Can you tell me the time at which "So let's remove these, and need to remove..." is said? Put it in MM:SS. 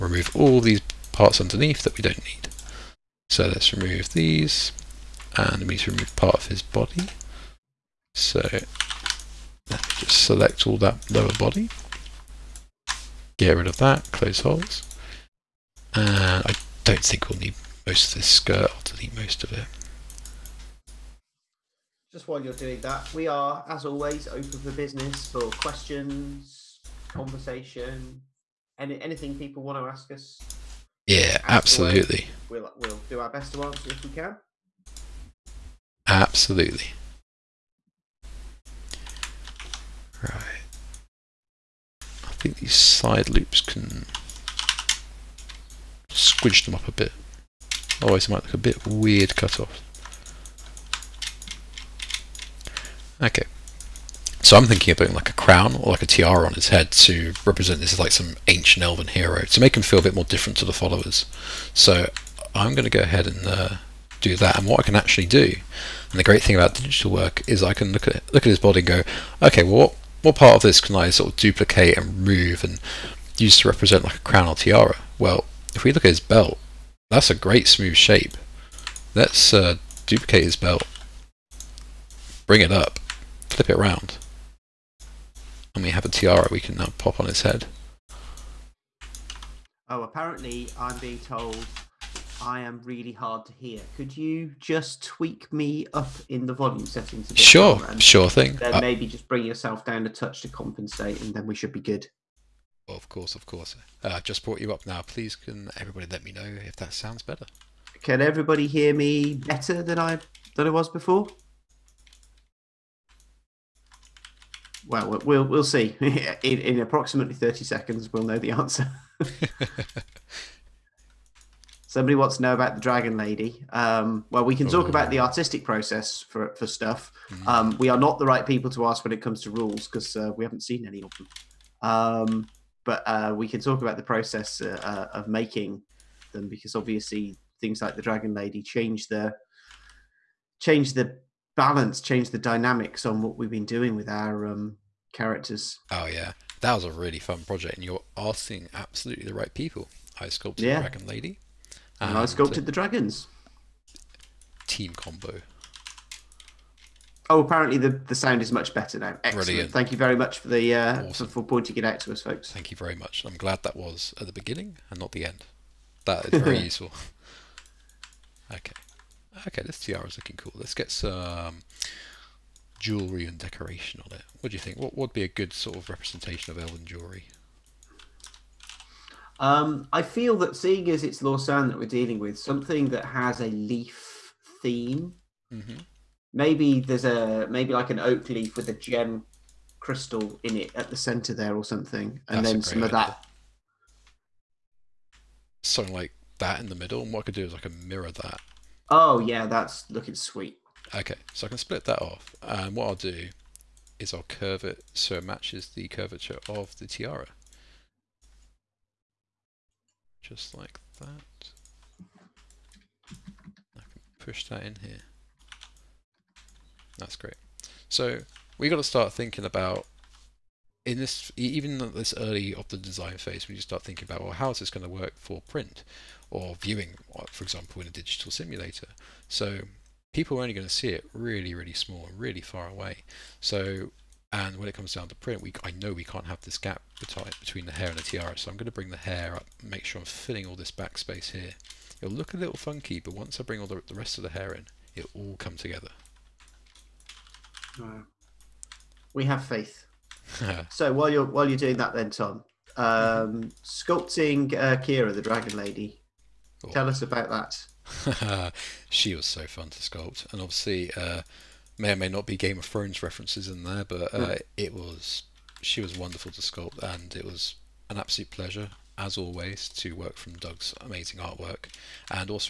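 00:03.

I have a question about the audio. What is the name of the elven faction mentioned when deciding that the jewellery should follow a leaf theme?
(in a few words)
Lorsann.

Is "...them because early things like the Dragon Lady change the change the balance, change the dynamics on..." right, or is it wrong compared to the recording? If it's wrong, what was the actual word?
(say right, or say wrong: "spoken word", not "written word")
wrong: "obviously", not "early".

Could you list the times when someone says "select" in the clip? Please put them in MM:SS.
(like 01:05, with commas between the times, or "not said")
00:10.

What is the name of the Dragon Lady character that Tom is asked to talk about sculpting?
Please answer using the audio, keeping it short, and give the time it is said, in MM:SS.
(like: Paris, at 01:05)
Keera, at 04:14.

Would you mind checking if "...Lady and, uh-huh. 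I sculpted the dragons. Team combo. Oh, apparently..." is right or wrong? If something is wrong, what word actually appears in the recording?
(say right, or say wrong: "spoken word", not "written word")
right.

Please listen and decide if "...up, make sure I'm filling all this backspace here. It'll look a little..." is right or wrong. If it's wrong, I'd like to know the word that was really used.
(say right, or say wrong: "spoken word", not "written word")
right.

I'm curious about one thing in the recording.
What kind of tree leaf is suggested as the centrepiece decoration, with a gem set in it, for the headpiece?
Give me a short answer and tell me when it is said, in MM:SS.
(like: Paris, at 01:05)
Oak, at 03:07.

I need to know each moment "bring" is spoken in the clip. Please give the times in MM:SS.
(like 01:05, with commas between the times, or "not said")
01:22, 01:39, 03:58, 04:03.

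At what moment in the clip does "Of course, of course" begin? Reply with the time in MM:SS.
01:42.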